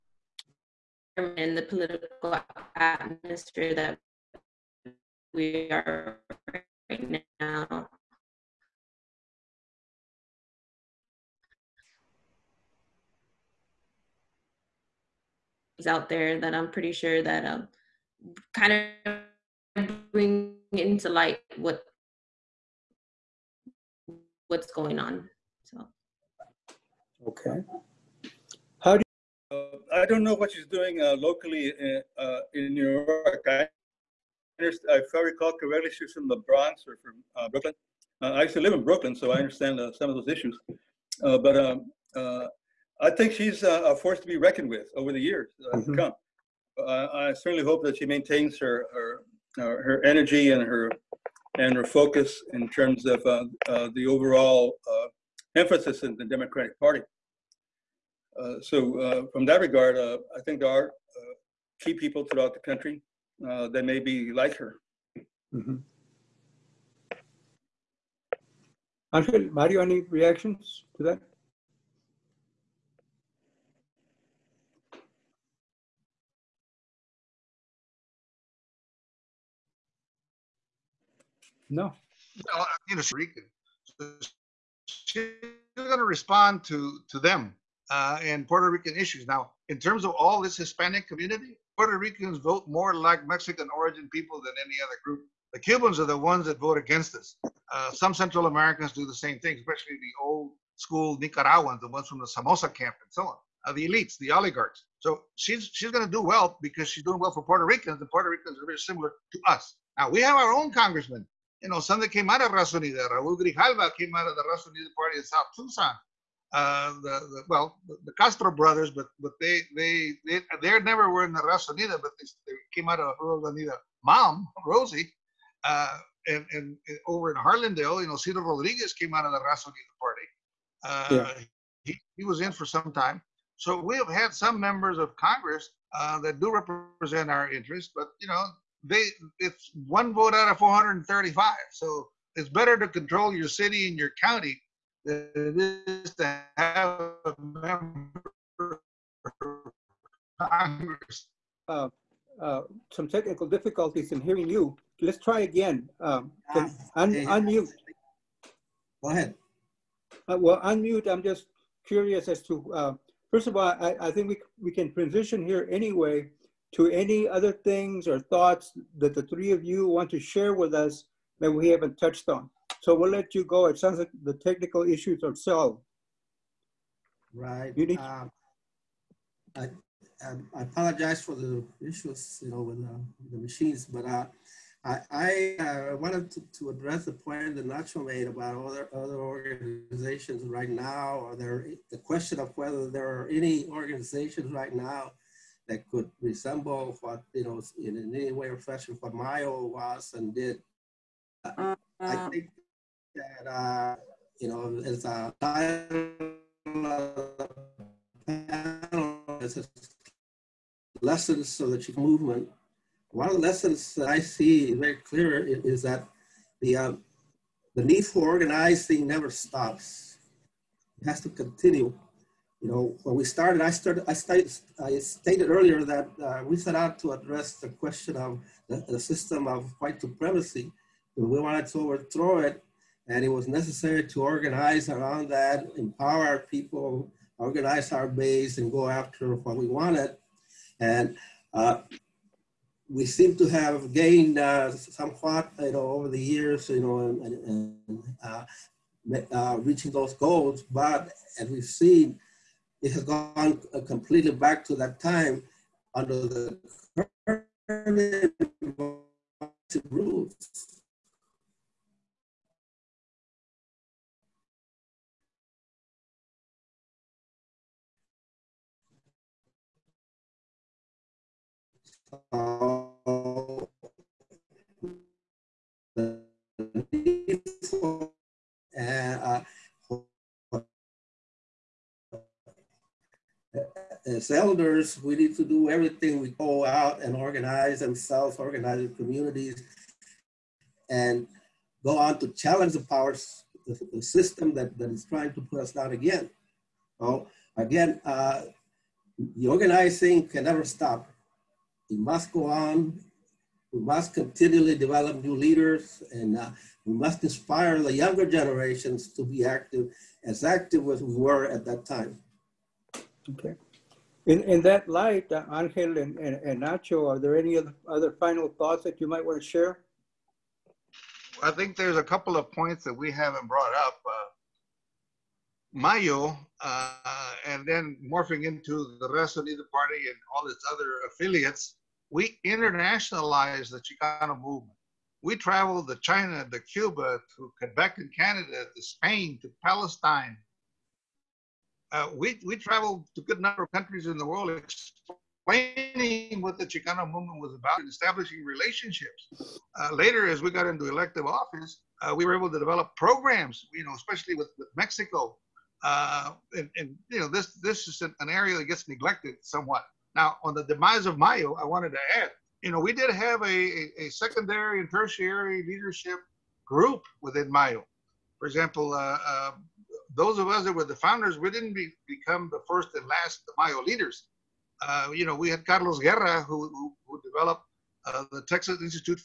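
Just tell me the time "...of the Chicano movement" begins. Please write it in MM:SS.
03:31.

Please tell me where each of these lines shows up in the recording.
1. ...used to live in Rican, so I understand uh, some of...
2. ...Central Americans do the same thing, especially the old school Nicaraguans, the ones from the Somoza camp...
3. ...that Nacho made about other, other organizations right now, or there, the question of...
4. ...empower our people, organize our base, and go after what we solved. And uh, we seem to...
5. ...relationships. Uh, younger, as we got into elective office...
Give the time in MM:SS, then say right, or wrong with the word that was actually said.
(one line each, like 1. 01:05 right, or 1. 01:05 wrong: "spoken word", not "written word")
1. 00:38 wrong: "Brooklyn", not "Rican"
2. 01:38 right
3. 03:07 right
4. 03:55 wrong: "wanted", not "solved"
5. 05:48 wrong: "later", not "younger".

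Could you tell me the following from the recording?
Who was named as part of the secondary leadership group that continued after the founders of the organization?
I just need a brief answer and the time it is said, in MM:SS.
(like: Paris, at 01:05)
Carlos Guerra, at 06:15.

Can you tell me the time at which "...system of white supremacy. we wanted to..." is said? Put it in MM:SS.
03:48.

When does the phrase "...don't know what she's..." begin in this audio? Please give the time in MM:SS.
00:30.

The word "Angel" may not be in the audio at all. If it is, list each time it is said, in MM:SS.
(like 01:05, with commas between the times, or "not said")
01:09, 05:15.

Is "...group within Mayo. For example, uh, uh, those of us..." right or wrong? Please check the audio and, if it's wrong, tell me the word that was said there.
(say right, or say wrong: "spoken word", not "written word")
right.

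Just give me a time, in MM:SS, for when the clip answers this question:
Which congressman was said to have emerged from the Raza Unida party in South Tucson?
01:53.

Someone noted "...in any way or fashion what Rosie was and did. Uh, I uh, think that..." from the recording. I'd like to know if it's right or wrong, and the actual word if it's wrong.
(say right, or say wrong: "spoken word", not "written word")
wrong: "Mayo", not "Rosie".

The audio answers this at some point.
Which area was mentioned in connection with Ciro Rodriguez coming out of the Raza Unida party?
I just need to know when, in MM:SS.
02:07.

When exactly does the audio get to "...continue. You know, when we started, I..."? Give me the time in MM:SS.
03:41.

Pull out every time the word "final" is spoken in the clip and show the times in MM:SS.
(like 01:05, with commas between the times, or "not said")
05:18.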